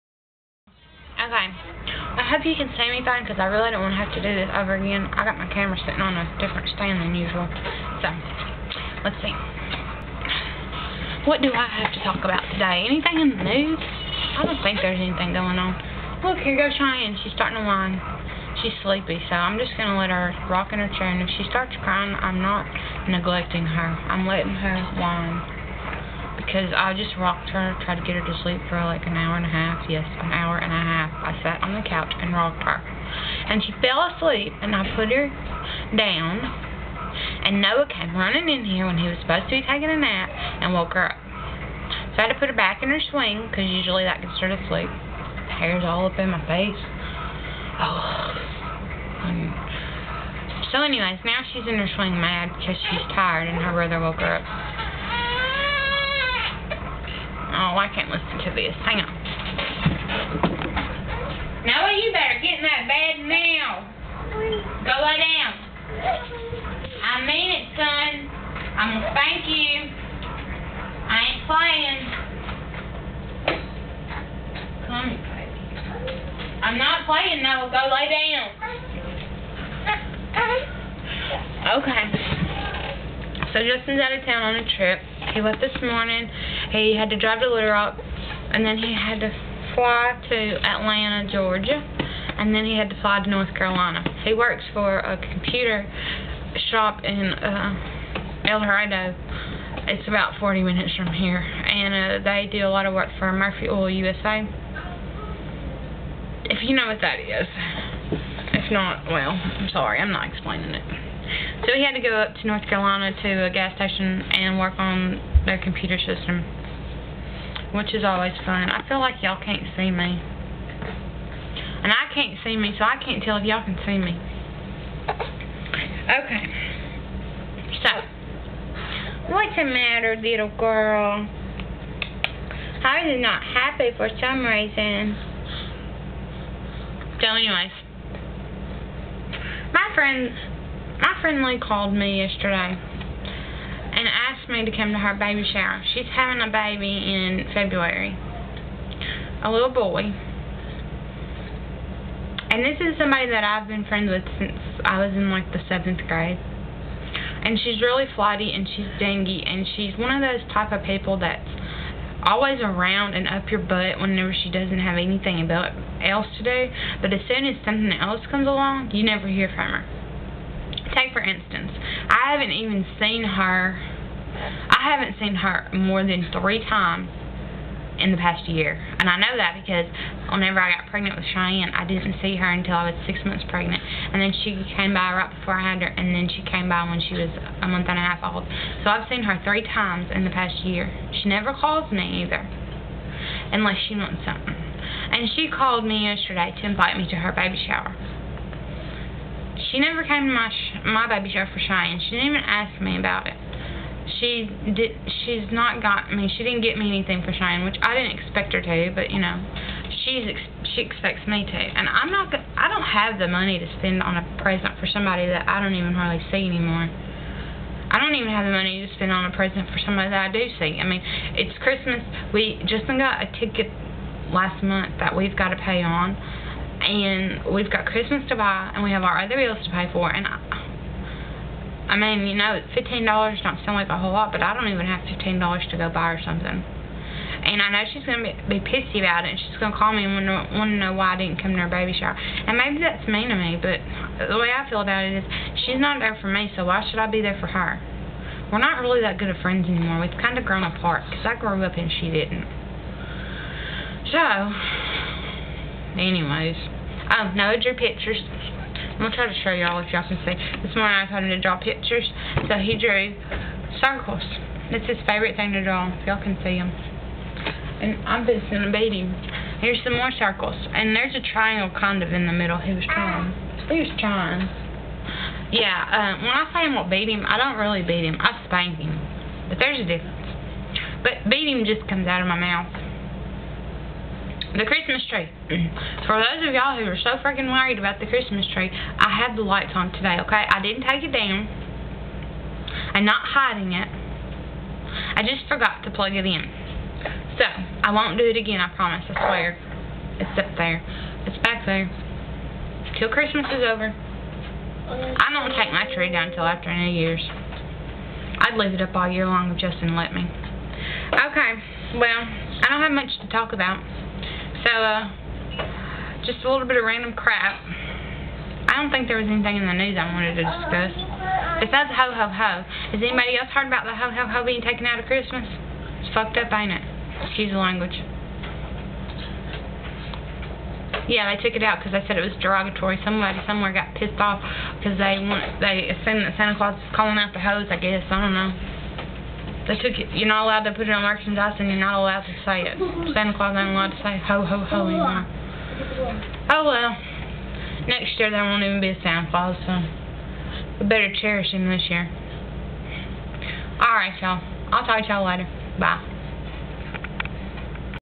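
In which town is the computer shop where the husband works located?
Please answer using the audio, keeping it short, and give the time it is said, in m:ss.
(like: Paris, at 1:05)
El Dorado, at 1:38.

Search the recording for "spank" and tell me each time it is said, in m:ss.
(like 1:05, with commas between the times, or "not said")
1:09, 4:38.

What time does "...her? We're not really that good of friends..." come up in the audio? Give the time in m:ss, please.
4:07.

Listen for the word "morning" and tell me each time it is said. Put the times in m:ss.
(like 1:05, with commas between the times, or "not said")
1:25, 4:20.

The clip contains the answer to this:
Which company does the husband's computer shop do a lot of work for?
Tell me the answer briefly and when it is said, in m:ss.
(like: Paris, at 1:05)
Murphy Oil USA, at 1:43.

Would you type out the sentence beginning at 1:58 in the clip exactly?
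I feel like y'all can't see me.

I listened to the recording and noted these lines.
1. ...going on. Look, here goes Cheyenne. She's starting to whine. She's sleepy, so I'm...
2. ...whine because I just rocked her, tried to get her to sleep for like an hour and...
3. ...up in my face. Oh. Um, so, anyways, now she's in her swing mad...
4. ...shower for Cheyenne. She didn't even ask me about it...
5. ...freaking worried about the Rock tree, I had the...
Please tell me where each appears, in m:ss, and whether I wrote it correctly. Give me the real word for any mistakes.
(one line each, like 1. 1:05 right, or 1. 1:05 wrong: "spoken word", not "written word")
1. 0:15 right
2. 0:24 right
3. 0:46 right
4. 3:21 right
5. 4:47 wrong: "Christmas", not "Rock".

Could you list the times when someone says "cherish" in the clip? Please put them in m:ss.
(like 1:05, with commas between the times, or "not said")
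5:51.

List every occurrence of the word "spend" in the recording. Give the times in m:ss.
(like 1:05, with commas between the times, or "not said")
3:33, 3:38.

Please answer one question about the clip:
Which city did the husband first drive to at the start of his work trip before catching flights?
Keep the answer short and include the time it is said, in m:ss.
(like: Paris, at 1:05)
Little Rock, at 1:27.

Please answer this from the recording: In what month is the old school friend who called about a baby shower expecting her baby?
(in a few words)
February.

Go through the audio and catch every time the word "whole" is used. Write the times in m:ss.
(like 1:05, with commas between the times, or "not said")
3:53.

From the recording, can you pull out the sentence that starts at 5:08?
I'd leave it up all year long if Justin let me.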